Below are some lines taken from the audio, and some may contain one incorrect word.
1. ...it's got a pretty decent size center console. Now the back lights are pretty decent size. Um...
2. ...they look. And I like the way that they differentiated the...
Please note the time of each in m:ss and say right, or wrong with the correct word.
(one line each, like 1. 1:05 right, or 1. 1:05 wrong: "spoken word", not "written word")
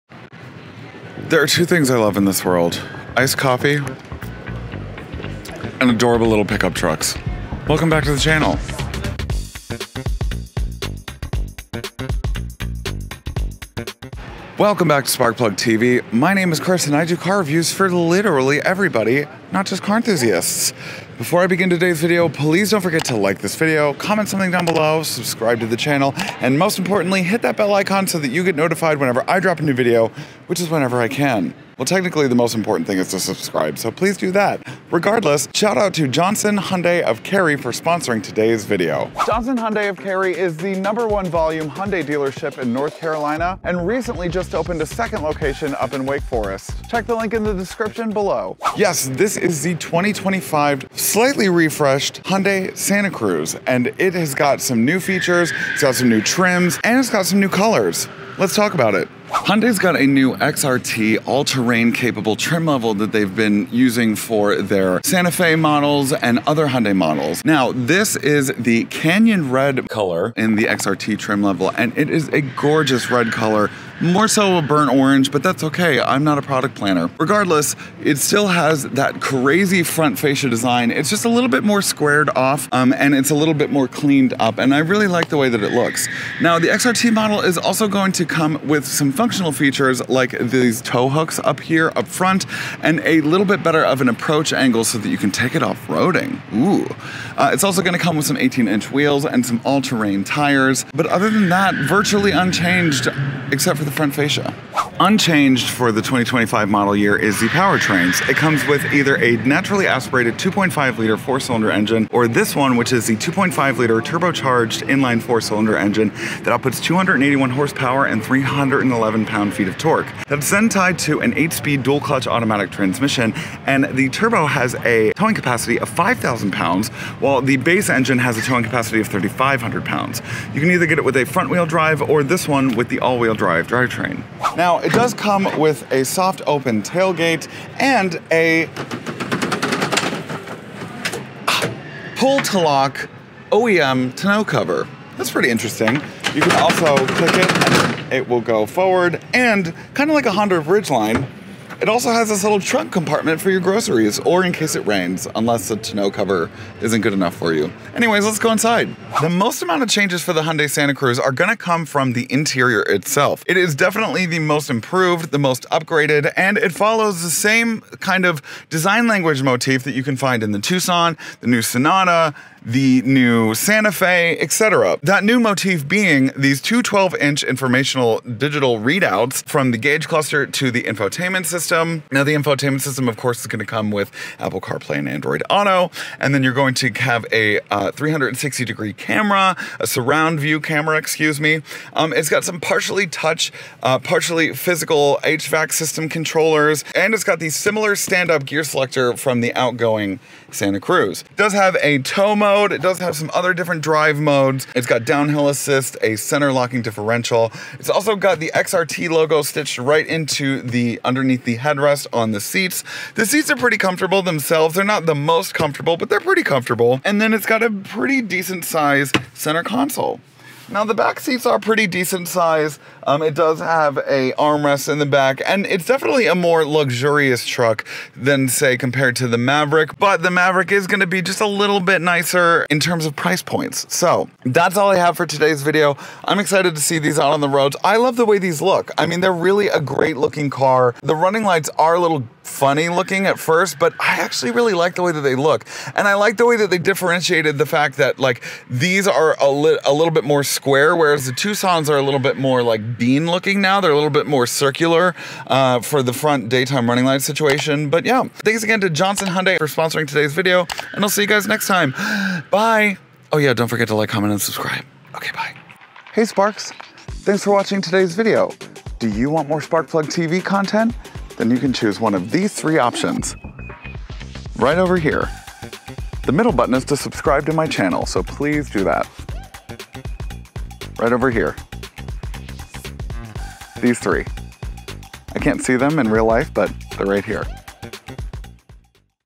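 1. 3:37 wrong: "seats", not "lights"
2. 4:05 right.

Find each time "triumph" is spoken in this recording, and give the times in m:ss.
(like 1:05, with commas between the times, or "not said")
not said.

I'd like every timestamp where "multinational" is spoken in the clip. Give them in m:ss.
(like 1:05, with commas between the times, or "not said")
not said.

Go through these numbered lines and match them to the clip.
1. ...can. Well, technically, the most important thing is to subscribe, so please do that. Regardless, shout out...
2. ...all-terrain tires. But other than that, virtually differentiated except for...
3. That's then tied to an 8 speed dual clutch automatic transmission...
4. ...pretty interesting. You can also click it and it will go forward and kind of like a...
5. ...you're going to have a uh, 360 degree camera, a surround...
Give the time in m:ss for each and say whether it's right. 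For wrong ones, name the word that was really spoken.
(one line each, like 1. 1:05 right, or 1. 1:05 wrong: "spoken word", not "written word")
1. 0:31 right
2. 1:39 wrong: "unchanged", not "differentiated"
3. 2:00 right
4. 2:25 right
5. 3:06 right.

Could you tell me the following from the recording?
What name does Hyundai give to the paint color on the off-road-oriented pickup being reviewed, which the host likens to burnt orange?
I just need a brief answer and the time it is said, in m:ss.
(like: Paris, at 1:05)
Canyon Red, at 1:08.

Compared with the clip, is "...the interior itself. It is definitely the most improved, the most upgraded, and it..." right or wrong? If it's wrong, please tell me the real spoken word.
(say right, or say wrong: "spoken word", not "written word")
right.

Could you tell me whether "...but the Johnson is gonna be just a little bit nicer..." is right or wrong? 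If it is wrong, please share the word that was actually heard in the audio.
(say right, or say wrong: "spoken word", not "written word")
wrong: "Maverick", not "Johnson".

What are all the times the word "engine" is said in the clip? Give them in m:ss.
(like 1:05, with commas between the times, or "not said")
1:51, 1:55, 2:07.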